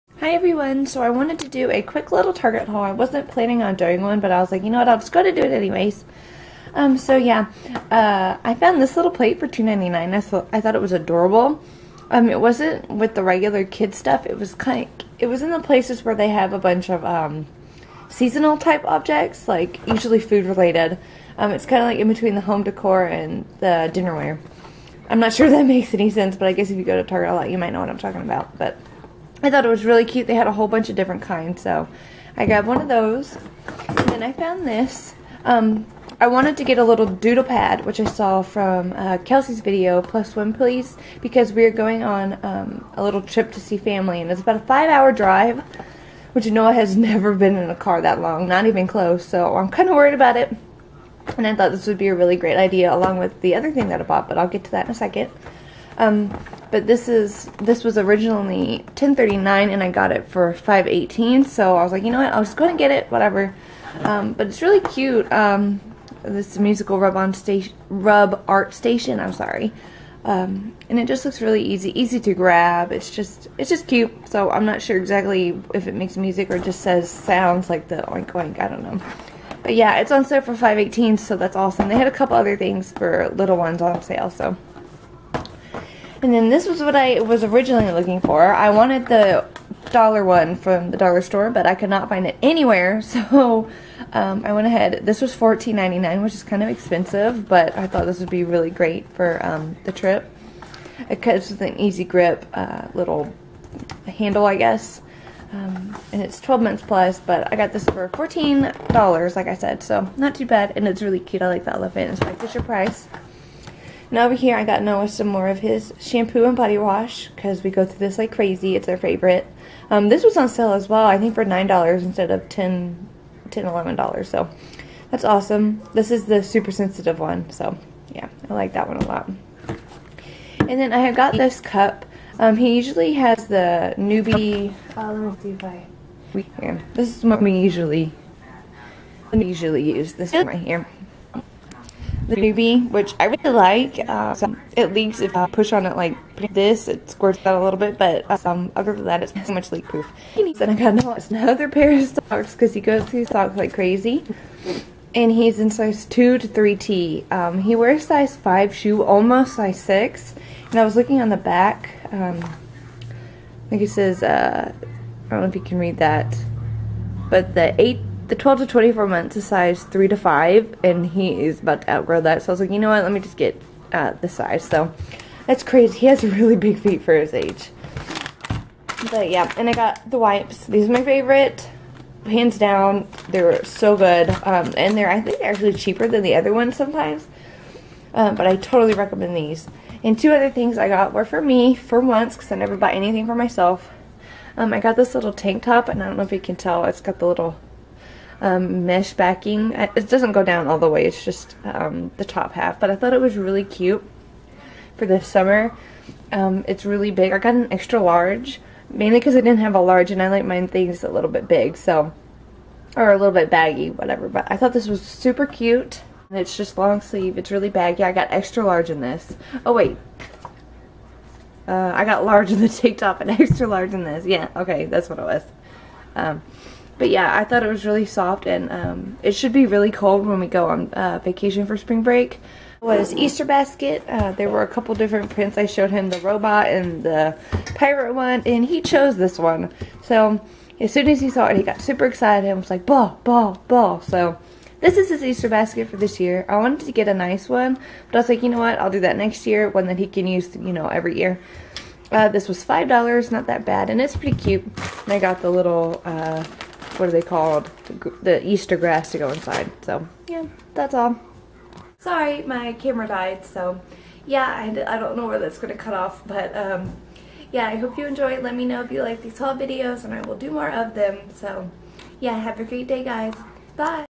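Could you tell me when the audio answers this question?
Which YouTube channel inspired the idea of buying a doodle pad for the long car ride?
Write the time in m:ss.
0:40.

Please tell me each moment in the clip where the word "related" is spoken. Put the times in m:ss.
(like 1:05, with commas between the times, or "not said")
0:20.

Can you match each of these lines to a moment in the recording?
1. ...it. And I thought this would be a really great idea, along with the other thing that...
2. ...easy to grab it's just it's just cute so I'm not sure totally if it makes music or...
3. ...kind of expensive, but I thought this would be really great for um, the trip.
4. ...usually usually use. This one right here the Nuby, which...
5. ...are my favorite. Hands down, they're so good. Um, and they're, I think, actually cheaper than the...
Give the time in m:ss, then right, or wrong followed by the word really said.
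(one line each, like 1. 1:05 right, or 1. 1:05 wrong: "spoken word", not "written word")
1. 0:50 right
2. 1:11 wrong: "exactly", not "totally"
3. 1:36 right
4. 2:17 right
5. 3:00 right.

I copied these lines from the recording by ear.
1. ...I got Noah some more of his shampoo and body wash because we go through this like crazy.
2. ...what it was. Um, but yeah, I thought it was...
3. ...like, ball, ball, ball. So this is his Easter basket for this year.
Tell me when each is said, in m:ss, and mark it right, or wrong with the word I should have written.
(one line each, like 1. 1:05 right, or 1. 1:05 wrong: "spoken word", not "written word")
1. 1:54 right
2. 3:45 right
3. 4:02 right.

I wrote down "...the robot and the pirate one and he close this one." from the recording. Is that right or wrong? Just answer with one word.
wrong.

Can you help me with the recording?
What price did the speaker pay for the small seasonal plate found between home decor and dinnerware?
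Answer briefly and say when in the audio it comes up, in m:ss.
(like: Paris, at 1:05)
$2.99, at 0:09.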